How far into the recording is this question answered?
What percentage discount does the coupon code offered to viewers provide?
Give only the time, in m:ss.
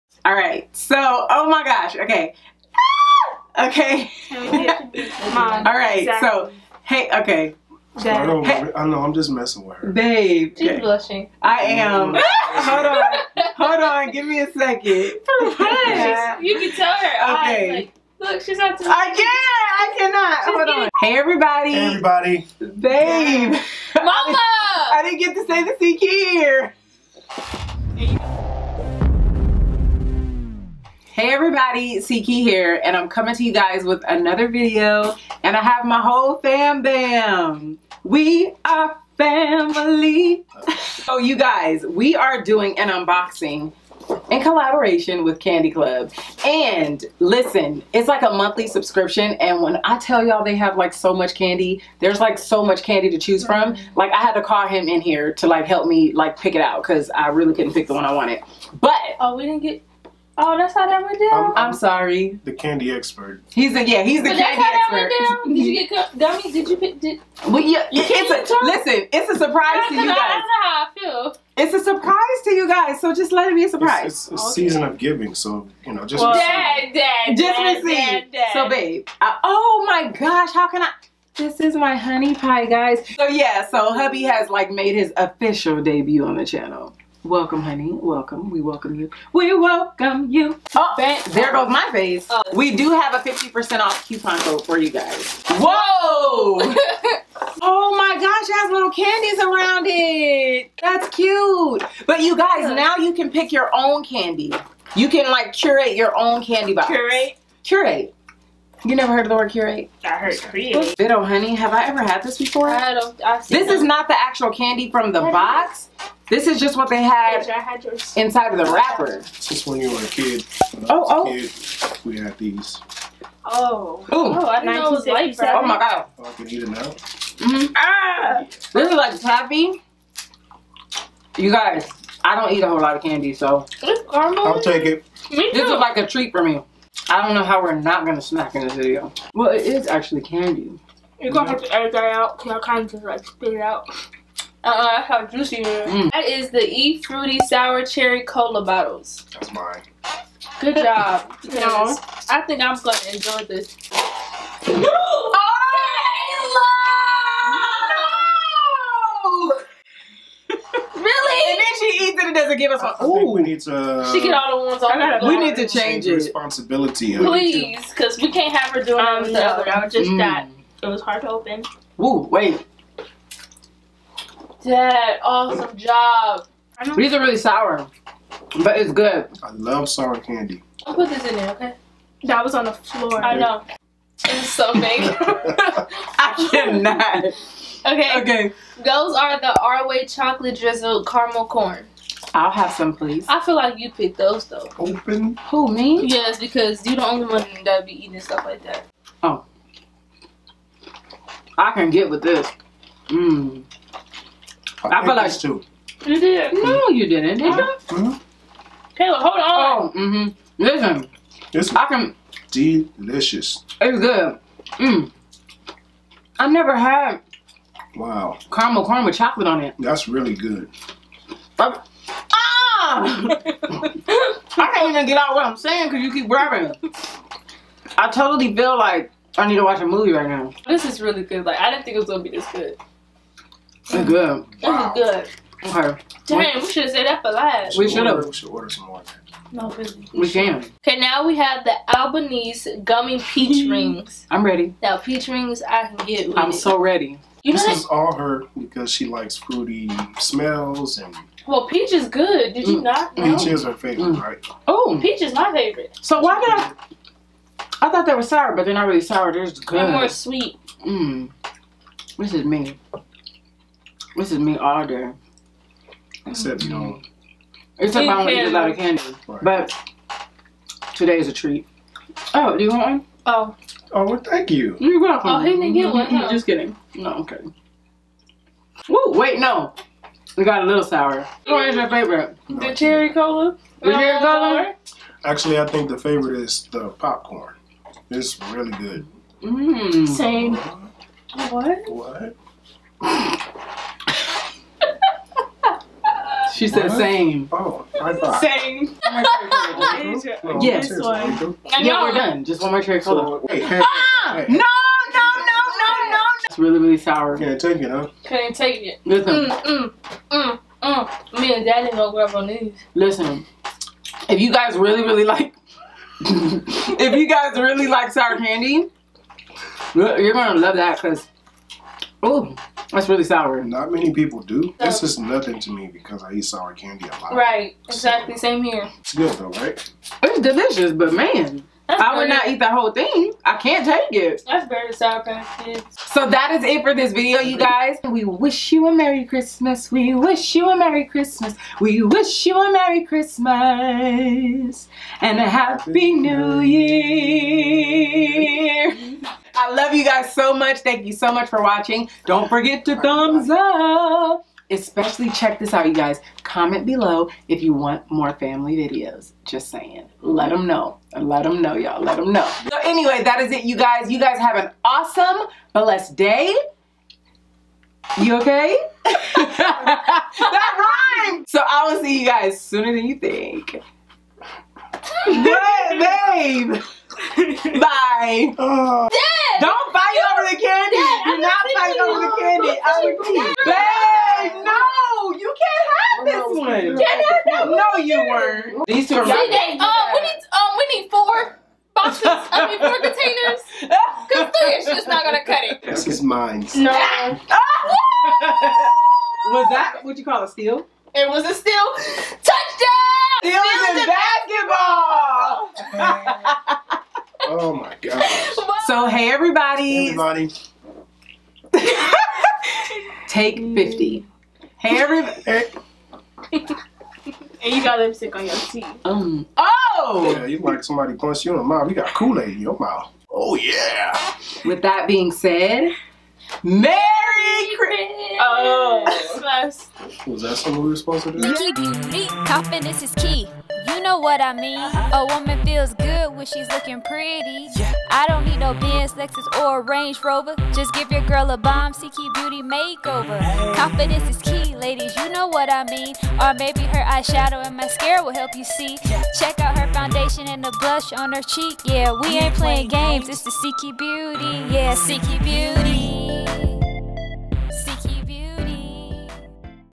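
1:33.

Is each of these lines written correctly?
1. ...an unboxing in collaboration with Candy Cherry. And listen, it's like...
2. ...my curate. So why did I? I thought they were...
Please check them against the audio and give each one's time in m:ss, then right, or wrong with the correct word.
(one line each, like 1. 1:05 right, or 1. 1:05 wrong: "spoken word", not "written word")
1. 0:42 wrong: "Club", not "Cherry"
2. 4:15 wrong: "favorite", not "curate".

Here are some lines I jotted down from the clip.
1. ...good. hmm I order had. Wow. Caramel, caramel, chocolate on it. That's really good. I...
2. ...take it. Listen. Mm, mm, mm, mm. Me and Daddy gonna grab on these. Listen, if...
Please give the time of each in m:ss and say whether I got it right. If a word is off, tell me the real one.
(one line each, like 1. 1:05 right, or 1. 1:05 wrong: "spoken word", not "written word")
1. 3:33 wrong: "never", not "order"
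2. 5:08 right.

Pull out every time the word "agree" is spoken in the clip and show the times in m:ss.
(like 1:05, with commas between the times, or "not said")
6:23.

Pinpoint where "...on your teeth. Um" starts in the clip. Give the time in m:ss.
6:58.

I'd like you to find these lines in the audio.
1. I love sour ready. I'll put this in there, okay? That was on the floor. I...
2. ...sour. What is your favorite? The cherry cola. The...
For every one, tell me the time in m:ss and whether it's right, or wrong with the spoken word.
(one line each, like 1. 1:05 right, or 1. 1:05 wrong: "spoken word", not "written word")
1. 2:59 wrong: "candy", not "ready"
2. 4:40 right.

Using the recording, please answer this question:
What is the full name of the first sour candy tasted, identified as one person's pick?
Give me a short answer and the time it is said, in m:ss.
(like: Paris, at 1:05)
E Fruity Sour Cherry Cola bottles, at 2:26.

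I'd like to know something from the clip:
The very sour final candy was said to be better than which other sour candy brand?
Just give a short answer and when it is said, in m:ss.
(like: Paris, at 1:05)
Sour Kids, at 5:34.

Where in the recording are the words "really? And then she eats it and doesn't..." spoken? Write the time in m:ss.
2:41.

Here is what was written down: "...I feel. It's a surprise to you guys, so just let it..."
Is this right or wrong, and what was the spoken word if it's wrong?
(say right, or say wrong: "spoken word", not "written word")
right.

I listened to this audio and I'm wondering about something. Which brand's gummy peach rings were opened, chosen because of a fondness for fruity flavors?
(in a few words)
Albanese.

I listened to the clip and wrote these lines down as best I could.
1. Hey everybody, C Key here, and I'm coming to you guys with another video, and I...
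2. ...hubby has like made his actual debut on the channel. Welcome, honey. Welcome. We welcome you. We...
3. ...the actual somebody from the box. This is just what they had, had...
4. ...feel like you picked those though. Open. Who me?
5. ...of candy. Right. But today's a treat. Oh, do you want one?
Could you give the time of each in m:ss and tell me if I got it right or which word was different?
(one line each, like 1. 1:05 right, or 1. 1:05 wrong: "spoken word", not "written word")
1. 0:31 right
2. 1:23 wrong: "official", not "actual"
3. 1:54 wrong: "candy", not "somebody"
4. 3:13 right
5. 4:28 right.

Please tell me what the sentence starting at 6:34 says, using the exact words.
Because three is just not going to cut it.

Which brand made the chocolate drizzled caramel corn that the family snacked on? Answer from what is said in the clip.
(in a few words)
Arway.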